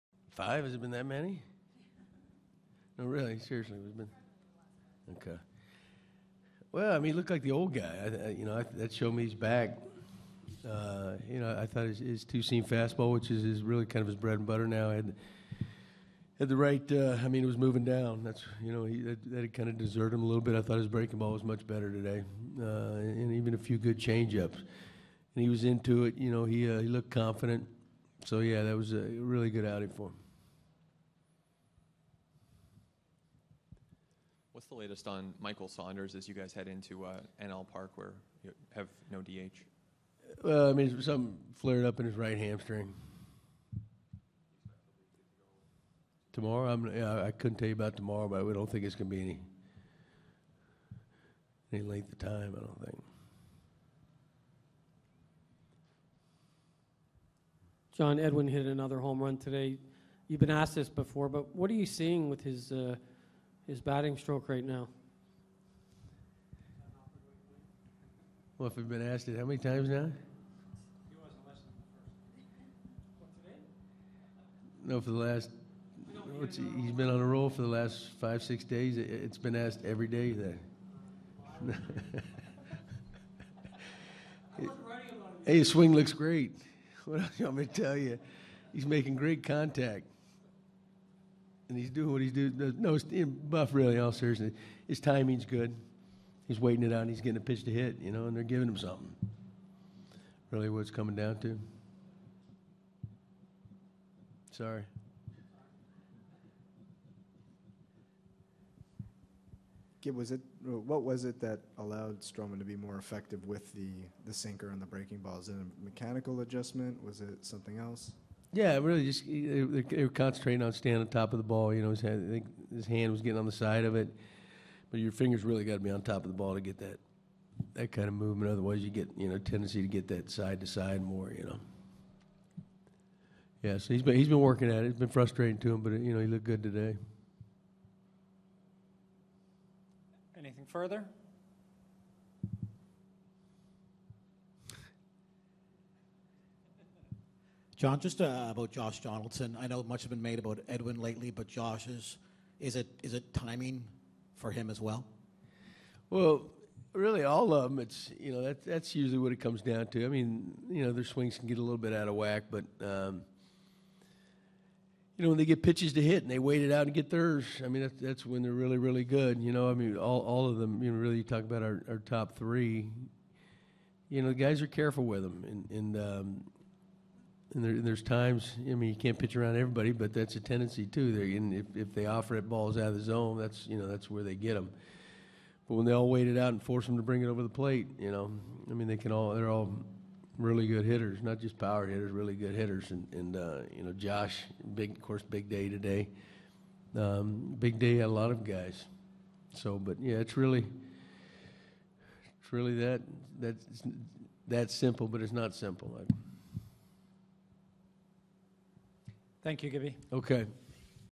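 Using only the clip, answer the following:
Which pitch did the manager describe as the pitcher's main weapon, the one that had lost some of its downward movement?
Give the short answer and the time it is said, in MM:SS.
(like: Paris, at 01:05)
two-seam fastball, at 00:12.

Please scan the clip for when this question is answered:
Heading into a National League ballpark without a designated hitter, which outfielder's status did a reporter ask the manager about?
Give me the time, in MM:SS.
00:35.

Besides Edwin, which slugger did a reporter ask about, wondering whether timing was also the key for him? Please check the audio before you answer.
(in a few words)
Josh Donaldson.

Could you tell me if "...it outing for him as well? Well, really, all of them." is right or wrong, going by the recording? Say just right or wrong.
wrong.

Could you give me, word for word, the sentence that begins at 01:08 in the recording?
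Well, if we've been asked it how many times now?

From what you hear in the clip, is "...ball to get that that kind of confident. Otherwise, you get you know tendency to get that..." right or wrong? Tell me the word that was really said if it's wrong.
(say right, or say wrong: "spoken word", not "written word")
wrong: "movement", not "confident".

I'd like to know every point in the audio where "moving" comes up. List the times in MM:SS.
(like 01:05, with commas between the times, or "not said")
00:17.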